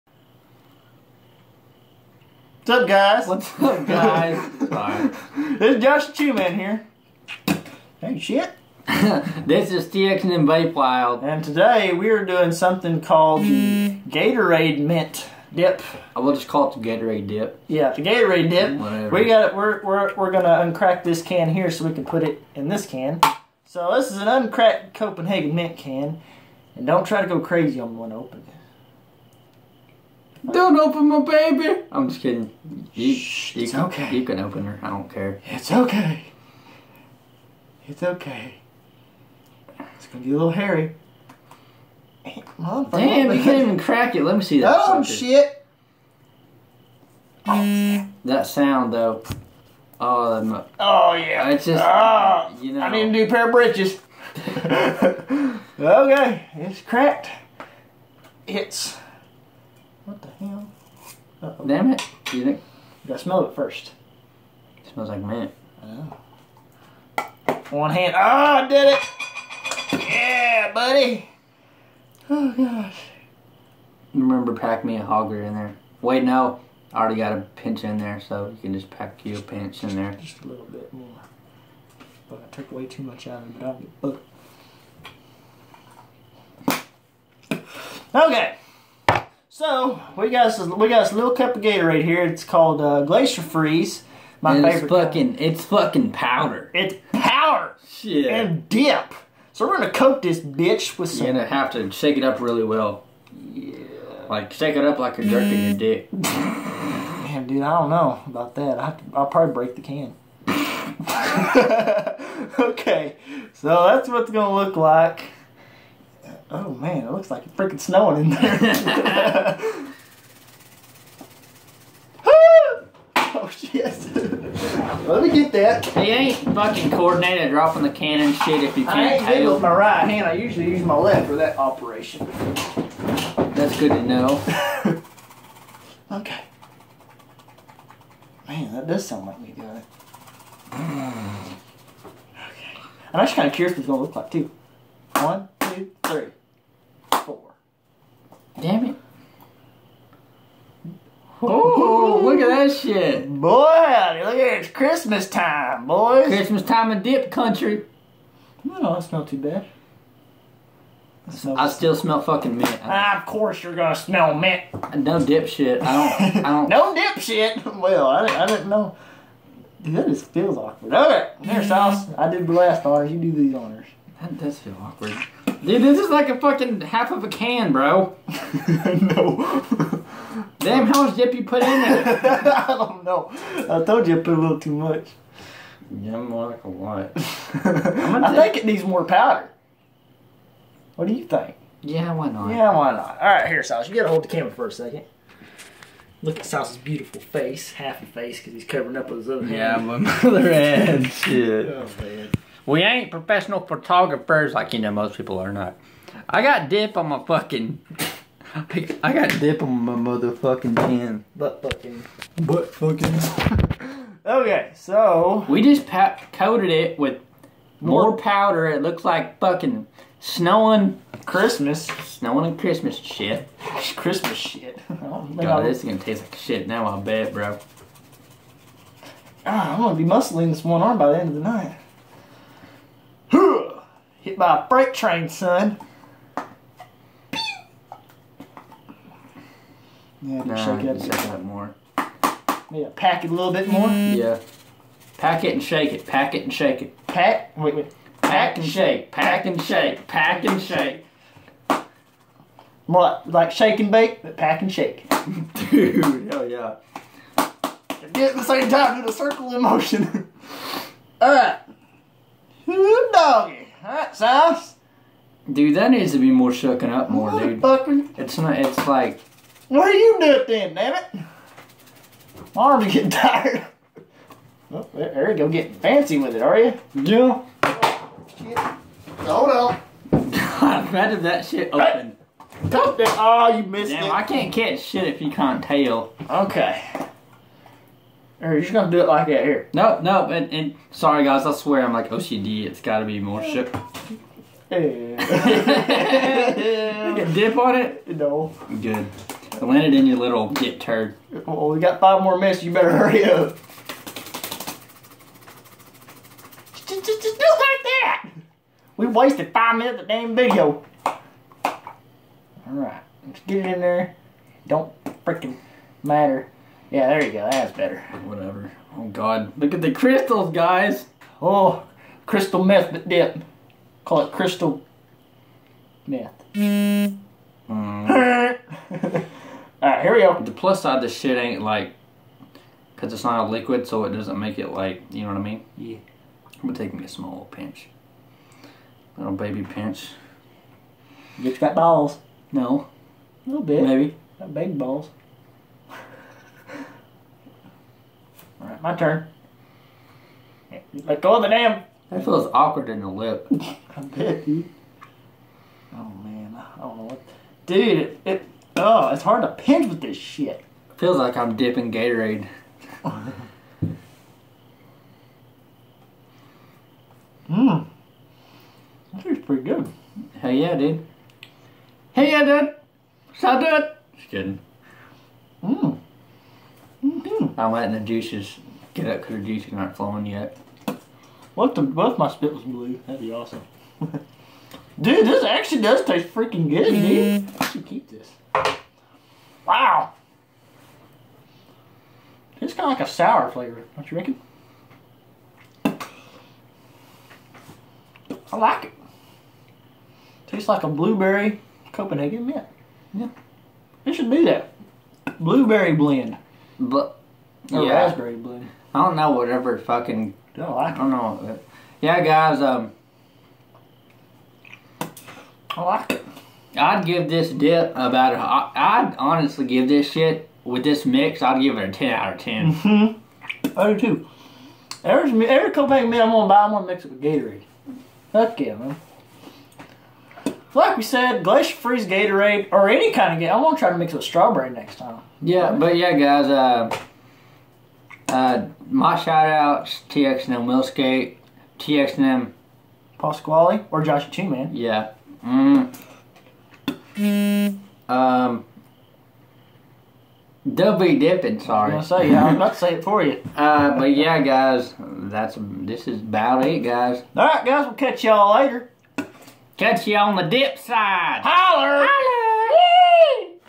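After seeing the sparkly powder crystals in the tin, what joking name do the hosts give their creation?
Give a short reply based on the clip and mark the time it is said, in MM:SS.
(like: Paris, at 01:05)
crystal meth dip, at 05:22.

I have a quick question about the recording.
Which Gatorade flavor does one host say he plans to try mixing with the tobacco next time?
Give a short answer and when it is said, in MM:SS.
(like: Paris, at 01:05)
strawberry, at 07:14.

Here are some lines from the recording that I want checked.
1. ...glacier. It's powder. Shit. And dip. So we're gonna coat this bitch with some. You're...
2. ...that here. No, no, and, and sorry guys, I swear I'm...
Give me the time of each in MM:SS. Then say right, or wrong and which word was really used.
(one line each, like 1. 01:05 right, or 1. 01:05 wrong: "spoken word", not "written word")
1. 01:36 wrong: "powder", not "glacier"
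2. 04:49 right.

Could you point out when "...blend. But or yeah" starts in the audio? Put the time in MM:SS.
06:45.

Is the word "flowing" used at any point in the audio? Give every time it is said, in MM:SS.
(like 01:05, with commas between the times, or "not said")
06:19.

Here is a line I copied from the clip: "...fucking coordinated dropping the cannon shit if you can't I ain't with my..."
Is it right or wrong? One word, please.
right.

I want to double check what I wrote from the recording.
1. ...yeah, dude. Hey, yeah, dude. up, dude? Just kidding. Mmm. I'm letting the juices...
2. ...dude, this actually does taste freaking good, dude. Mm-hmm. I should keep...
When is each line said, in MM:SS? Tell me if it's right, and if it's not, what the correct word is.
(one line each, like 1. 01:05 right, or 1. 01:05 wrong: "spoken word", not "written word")
1. 06:10 right
2. 06:24 right.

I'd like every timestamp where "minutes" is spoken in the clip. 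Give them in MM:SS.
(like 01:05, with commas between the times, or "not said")
05:02, 05:09.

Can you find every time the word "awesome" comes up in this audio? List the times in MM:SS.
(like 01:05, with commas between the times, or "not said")
06:23.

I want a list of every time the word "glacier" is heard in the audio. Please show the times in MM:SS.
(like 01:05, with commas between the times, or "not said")
01:33, 07:11.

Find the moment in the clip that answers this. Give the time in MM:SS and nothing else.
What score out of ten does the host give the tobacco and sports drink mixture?
07:01.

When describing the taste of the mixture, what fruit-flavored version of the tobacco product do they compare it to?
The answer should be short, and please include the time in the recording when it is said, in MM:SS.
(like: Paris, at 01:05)
blueberry Copenhagen mint, at 06:40.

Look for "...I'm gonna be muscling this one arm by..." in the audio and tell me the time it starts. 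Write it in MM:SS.
03:49.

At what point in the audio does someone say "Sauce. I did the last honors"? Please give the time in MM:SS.
02:51.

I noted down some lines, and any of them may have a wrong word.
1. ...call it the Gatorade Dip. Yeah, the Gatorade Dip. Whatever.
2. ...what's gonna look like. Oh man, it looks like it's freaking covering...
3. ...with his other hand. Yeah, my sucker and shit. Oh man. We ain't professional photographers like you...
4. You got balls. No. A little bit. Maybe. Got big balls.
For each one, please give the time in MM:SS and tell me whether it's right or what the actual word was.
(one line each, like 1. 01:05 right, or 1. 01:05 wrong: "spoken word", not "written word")
1. 00:16 right
2. 01:54 wrong: "snowing", not "covering"
3. 03:19 wrong: "mother", not "sucker"
4. 05:41 right.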